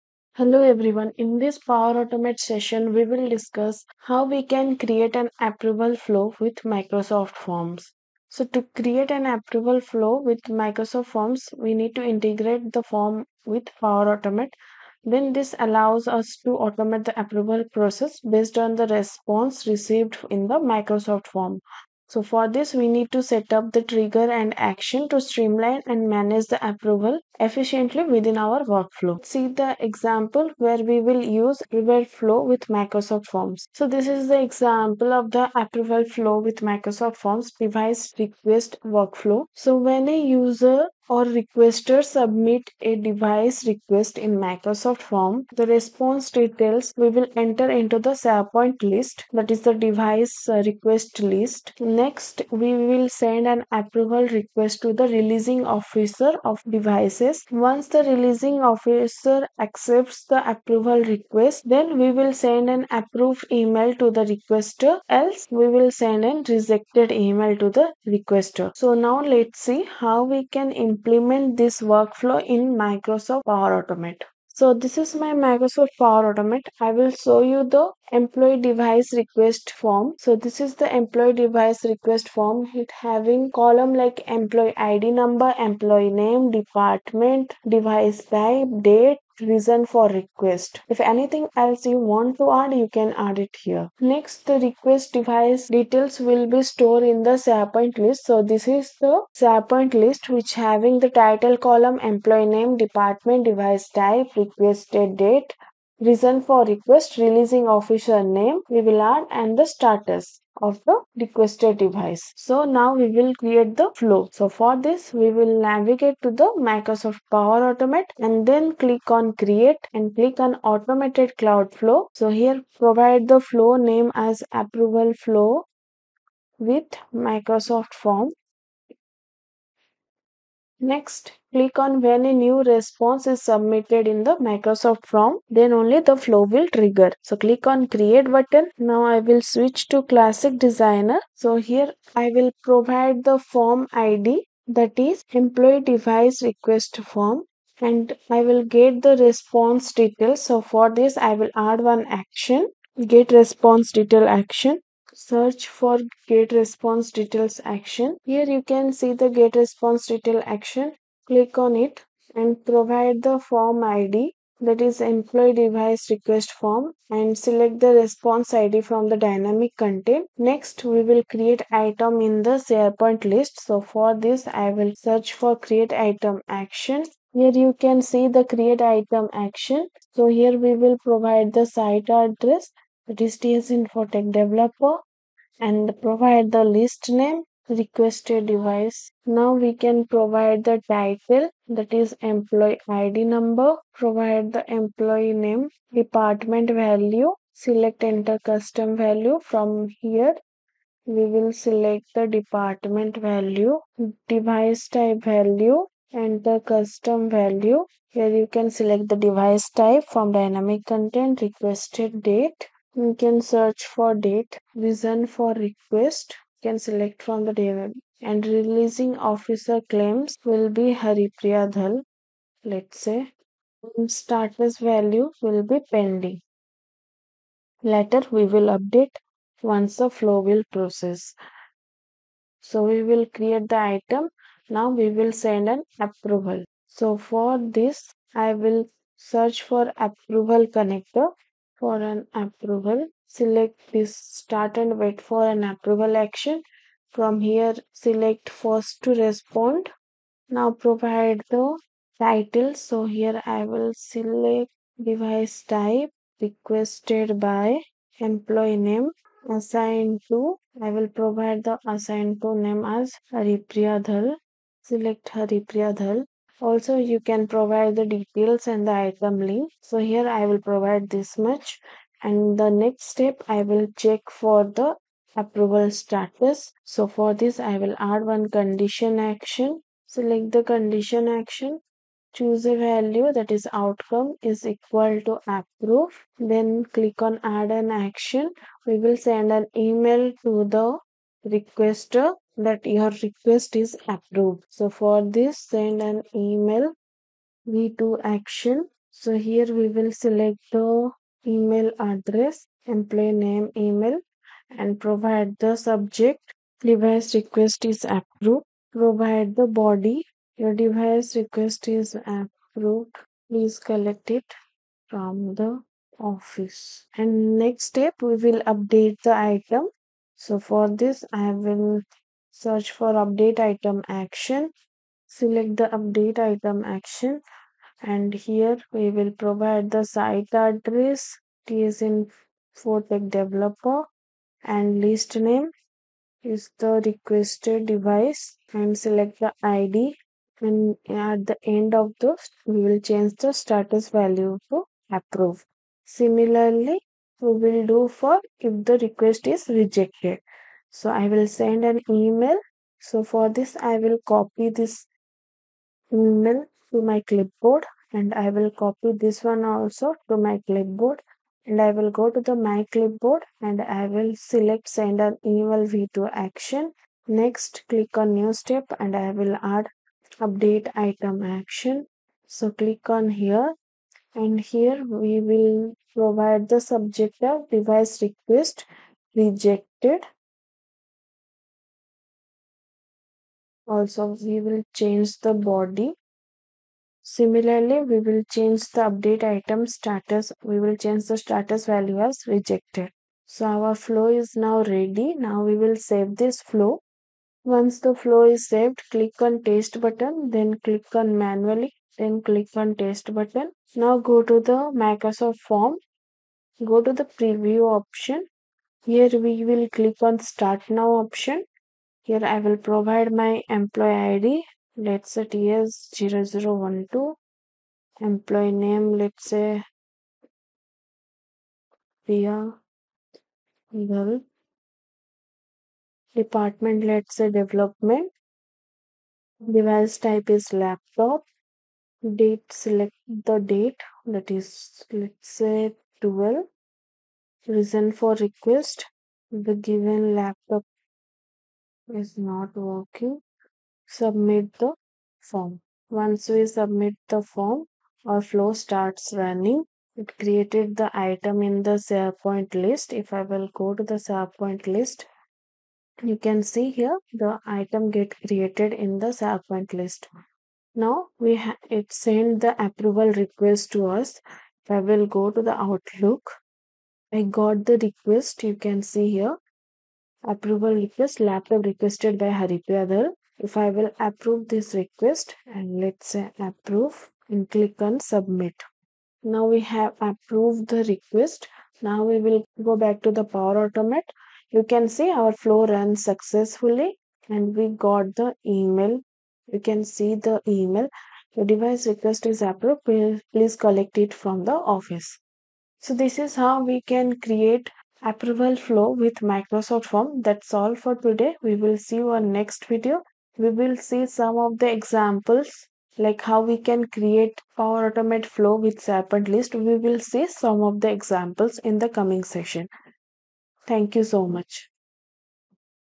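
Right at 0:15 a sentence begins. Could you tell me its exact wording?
Then this allows us to automate the approval process based on the response received in the Microsoft form.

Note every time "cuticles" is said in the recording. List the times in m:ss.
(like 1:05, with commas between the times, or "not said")
not said.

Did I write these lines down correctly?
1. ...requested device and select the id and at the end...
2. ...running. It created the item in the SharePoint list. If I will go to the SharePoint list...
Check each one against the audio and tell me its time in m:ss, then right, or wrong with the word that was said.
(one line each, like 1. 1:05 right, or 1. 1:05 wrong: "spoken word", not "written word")
1. 5:37 right
2. 7:29 right.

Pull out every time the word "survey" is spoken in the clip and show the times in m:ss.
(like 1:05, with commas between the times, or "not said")
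not said.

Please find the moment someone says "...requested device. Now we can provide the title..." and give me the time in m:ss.
3:07.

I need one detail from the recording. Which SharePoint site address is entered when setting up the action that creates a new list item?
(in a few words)
TSInfoTech developer.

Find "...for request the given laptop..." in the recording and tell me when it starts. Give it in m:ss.
7:18.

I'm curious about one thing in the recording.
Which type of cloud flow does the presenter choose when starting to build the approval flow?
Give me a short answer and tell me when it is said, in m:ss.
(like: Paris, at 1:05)
Automated cloud flow, at 2:00.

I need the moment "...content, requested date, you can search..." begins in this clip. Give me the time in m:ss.
3:30.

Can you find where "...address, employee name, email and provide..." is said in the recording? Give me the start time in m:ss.
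5:01.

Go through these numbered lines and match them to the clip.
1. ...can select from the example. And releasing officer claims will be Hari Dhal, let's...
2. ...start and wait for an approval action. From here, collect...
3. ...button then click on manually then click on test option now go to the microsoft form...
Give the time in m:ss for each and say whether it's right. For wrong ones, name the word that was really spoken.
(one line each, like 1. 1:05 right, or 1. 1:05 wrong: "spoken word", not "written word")
1. 3:36 wrong: "table", not "example"
2. 4:04 wrong: "select", not "collect"
3. 6:40 wrong: "button", not "option".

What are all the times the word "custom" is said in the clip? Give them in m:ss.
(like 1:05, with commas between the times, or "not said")
3:18, 3:26.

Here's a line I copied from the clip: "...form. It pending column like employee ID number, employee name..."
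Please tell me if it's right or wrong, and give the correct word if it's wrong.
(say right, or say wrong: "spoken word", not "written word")
wrong: "having", not "pending".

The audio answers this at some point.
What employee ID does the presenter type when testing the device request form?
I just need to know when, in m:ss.
6:55.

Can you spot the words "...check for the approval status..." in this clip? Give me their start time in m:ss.
4:34.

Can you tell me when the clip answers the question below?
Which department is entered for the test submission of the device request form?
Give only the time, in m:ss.
7:07.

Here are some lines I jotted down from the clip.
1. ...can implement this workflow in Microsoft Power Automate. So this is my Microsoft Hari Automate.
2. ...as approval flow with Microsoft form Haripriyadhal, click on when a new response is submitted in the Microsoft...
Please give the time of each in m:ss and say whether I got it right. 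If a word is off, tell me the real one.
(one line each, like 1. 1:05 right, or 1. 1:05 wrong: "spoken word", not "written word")
1. 1:10 wrong: "Power", not "Hari"
2. 2:04 wrong: "Next", not "Haripriyadhal".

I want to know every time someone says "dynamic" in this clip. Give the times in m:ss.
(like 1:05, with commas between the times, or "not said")
2:49, 3:30.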